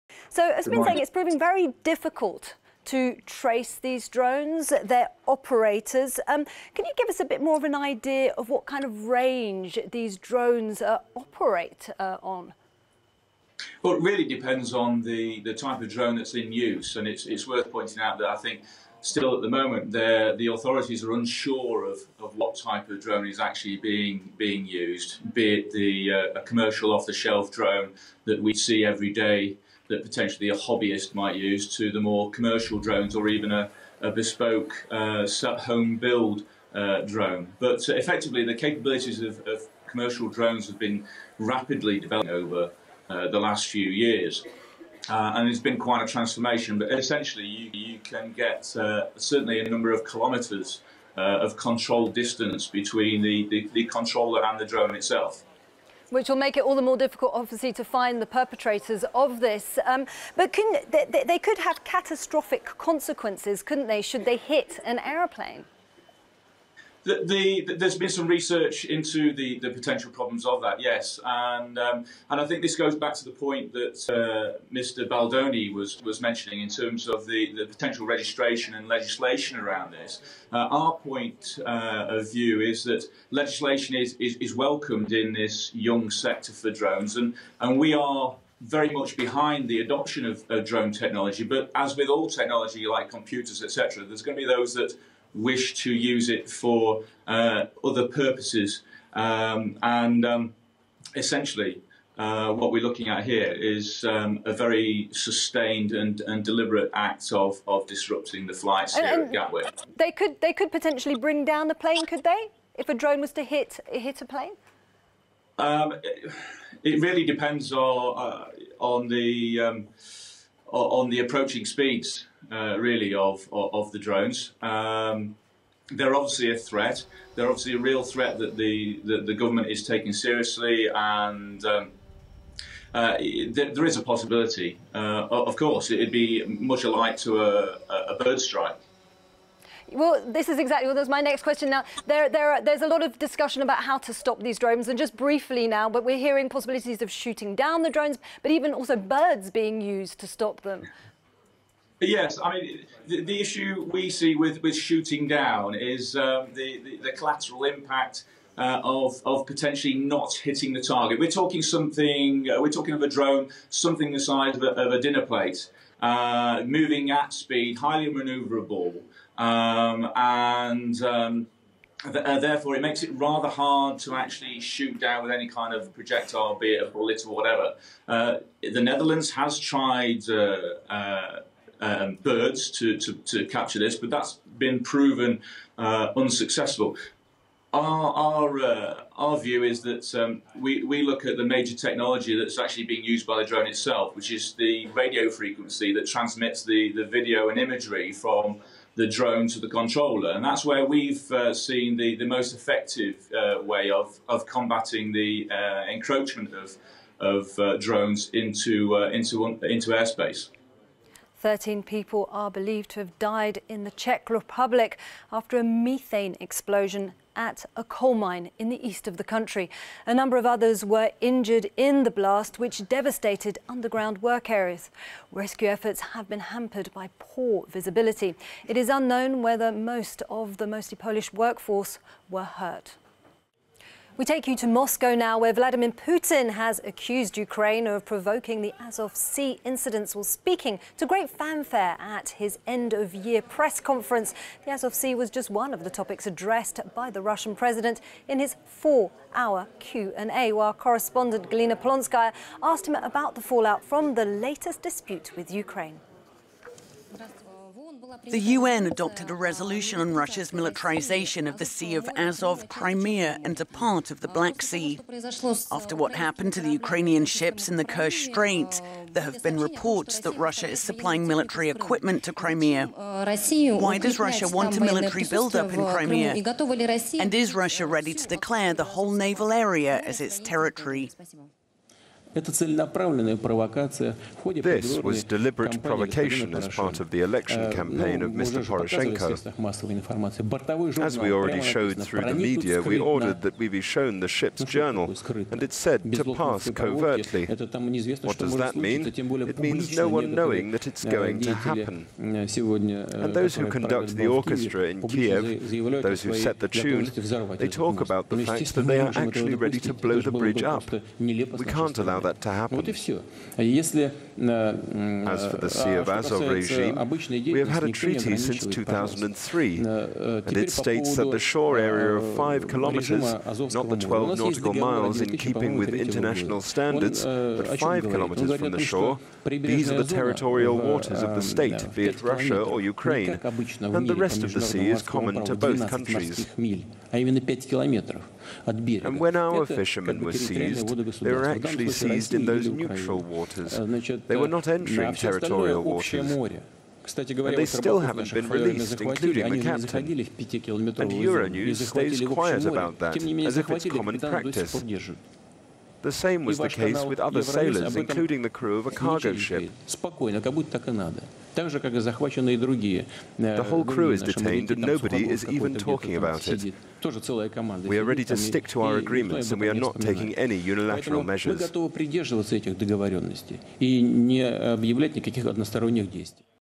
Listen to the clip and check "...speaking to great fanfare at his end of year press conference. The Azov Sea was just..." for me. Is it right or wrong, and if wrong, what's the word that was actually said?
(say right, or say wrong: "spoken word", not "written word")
right.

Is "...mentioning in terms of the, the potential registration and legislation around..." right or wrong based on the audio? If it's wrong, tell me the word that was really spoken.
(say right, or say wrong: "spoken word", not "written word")
right.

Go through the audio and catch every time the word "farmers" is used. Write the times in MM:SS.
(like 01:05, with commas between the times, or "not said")
not said.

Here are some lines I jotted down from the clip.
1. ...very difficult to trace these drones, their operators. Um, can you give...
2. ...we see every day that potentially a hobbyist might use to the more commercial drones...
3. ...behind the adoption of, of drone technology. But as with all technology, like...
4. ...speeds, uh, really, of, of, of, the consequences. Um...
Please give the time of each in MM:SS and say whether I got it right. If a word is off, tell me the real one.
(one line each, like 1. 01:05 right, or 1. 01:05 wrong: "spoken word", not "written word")
1. 00:01 right
2. 00:28 right
3. 01:29 right
4. 02:01 wrong: "drones", not "consequences".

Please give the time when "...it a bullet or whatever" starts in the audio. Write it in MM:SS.
02:56.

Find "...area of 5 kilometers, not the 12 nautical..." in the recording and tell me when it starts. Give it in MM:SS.
05:21.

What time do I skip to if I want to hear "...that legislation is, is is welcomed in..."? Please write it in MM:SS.
01:22.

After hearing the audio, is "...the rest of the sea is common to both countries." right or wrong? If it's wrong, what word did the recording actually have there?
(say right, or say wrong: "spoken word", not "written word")
right.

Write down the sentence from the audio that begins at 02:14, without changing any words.
Uh, of course, it'd be much alike to a, a bird strike.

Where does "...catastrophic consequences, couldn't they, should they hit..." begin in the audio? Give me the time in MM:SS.
01:01.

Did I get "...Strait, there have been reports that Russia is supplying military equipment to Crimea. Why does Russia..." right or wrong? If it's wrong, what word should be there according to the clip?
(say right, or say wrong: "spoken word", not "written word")
right.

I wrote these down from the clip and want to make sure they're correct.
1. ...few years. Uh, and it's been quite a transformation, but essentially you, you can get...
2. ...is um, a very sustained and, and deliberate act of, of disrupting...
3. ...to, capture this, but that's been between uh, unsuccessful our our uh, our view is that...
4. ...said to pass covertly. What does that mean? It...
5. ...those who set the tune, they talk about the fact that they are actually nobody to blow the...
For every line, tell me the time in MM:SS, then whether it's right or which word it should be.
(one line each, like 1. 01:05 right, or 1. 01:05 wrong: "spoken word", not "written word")
1. 00:43 right
2. 01:43 right
3. 03:03 wrong: "proven", not "between"
4. 04:55 right
5. 05:06 wrong: "ready", not "nobody".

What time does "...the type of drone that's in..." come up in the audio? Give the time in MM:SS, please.
00:15.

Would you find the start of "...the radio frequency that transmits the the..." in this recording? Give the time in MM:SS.
03:14.